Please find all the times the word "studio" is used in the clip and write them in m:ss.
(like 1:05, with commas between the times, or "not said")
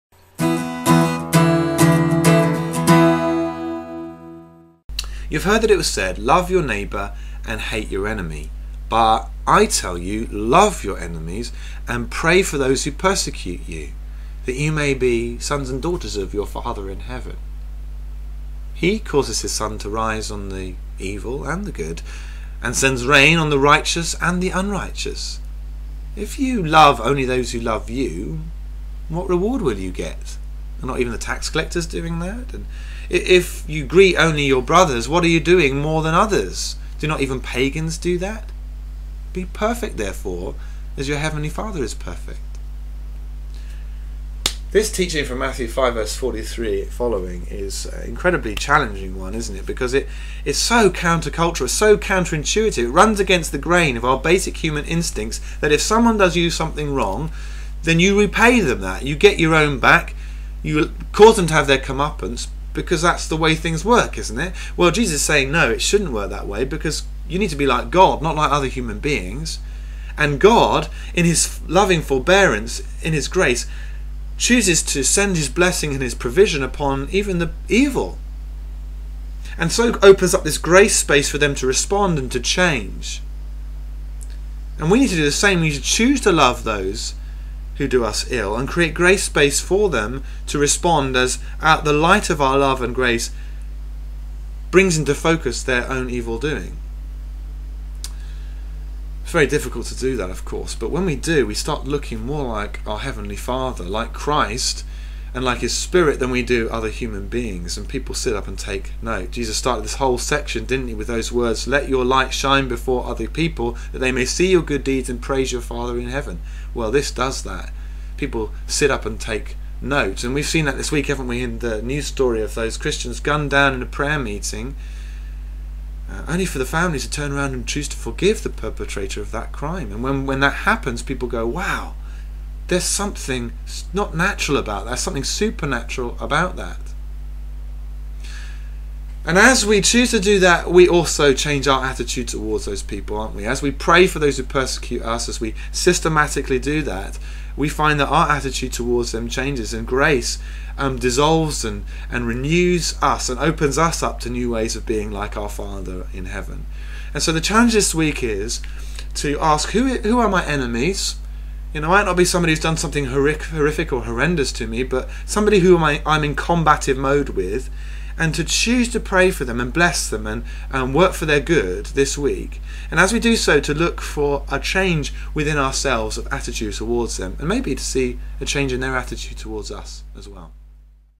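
not said.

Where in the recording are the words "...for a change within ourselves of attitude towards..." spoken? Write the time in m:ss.
2:54.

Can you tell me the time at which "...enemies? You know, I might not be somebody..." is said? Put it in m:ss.
2:40.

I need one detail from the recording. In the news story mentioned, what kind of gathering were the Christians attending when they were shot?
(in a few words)
a prayer meeting.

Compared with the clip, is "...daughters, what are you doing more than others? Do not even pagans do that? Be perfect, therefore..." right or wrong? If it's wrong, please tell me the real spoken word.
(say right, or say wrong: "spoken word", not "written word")
wrong: "brothers", not "daughters".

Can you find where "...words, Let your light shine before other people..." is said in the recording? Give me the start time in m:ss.
1:51.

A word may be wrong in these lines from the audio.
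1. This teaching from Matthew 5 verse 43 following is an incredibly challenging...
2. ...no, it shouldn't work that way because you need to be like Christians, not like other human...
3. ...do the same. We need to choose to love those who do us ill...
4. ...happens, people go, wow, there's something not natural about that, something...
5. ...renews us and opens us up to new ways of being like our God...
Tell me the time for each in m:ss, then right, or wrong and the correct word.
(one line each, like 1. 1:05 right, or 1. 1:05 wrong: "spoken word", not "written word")
1. 0:44 right
2. 1:05 wrong: "God", not "Christians"
3. 1:25 right
4. 2:10 right
5. 2:32 wrong: "Father", not "God".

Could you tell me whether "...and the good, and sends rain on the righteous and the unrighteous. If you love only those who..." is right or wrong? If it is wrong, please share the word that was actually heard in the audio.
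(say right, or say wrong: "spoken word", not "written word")
right.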